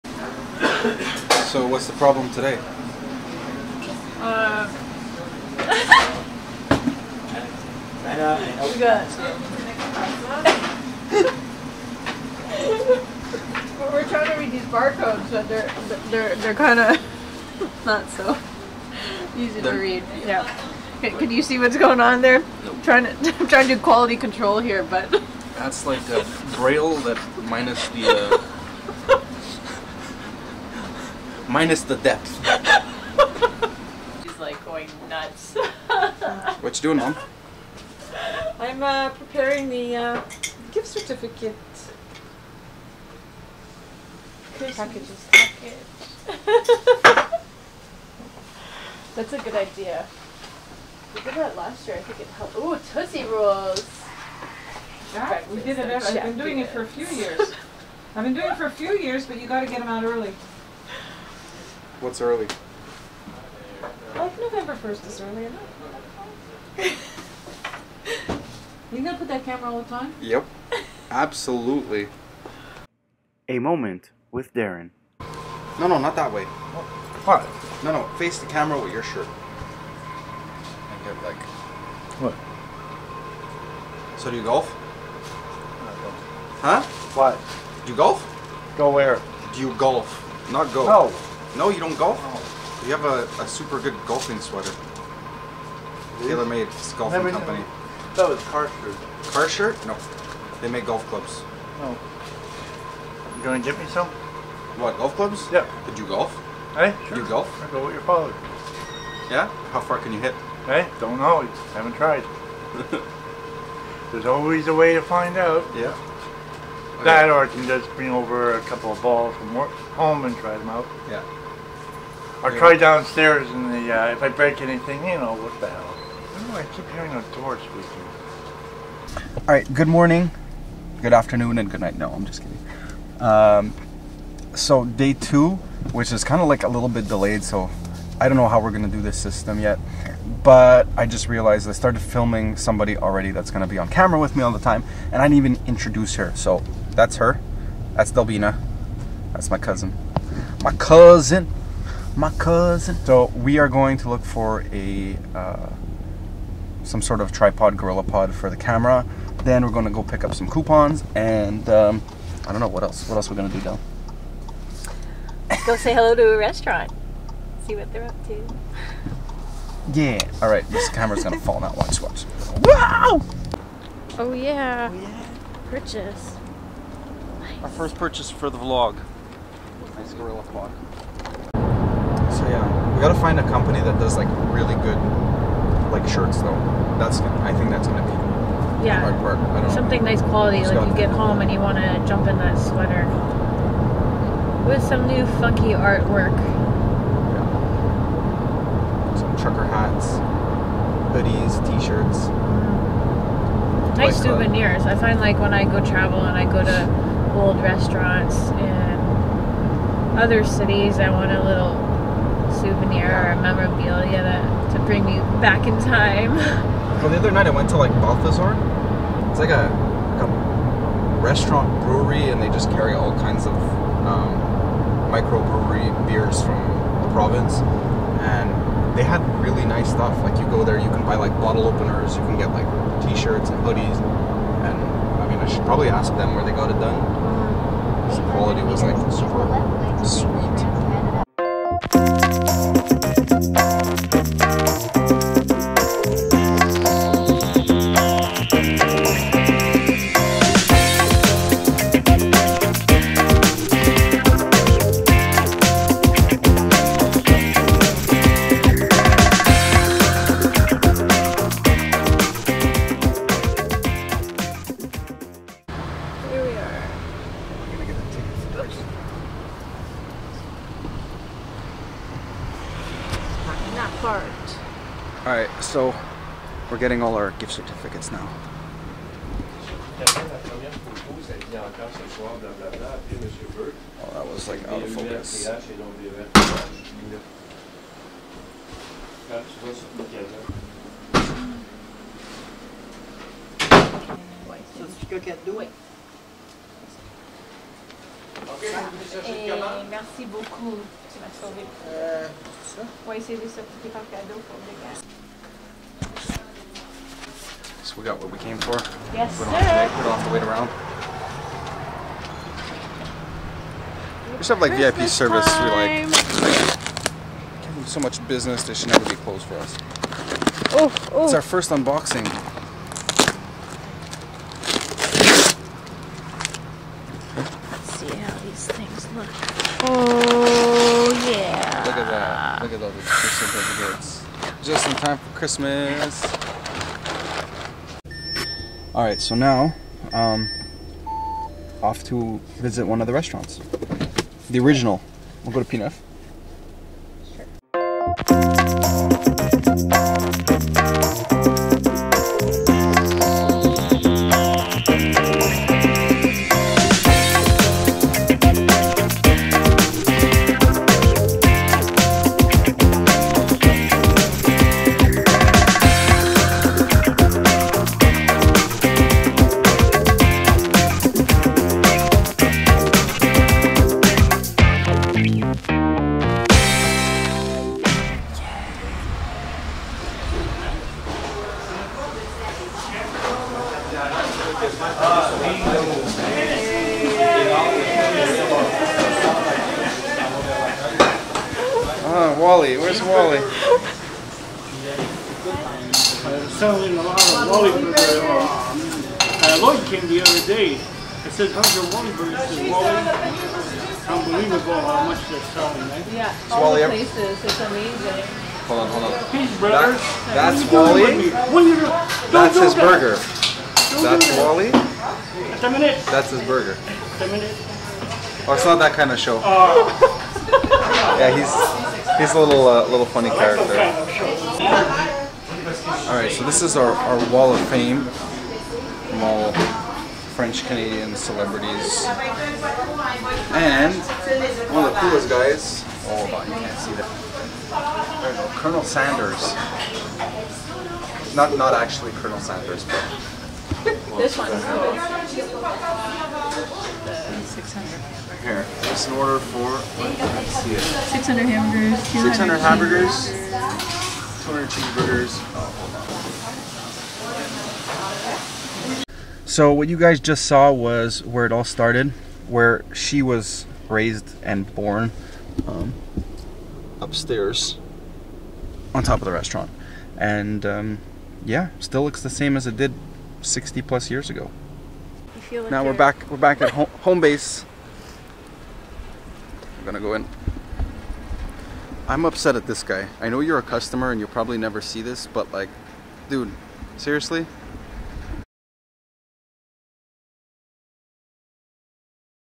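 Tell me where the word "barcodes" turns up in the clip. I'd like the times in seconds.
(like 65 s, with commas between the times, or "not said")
14 s.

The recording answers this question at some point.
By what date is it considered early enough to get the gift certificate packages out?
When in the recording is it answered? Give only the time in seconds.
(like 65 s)
64 s.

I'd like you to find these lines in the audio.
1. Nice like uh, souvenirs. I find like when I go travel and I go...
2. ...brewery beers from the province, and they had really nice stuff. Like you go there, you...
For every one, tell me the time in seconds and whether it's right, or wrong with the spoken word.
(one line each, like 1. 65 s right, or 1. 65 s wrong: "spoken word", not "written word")
1. 203 s right
2. 225 s wrong: "microbrewery", not "brewery".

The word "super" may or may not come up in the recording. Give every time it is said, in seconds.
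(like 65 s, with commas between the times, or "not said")
93 s, 239 s.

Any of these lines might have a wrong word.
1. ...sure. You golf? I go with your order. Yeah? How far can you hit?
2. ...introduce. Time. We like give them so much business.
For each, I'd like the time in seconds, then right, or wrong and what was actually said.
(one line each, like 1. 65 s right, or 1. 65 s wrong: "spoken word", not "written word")
1. 107 s wrong: "father", not "order"
2. 315 s wrong: "service", not "introduce".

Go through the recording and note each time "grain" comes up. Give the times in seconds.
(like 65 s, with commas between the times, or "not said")
not said.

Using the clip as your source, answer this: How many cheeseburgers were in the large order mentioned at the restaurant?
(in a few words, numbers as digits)
200.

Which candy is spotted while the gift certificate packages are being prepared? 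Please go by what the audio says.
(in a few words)
Tootsie Rolls.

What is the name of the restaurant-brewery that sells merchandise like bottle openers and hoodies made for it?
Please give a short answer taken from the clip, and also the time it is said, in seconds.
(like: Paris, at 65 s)
Balthazar, at 218 s.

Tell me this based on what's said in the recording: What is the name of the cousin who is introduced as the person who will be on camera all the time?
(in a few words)
Delbina.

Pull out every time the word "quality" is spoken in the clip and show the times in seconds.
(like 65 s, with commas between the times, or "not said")
23 s, 190 s, 238 s.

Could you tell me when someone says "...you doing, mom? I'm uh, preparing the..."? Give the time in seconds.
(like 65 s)
36 s.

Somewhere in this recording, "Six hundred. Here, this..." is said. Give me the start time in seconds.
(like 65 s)
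447 s.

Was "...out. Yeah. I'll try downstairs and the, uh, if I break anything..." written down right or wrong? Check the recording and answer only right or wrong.
right.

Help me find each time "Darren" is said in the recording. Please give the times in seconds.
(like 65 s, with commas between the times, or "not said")
74 s.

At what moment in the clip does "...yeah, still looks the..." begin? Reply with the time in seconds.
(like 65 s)
471 s.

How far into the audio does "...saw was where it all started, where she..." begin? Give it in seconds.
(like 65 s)
460 s.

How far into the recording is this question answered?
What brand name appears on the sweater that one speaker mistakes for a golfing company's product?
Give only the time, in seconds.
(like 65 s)
96 s.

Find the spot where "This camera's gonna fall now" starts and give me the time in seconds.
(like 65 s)
170 s.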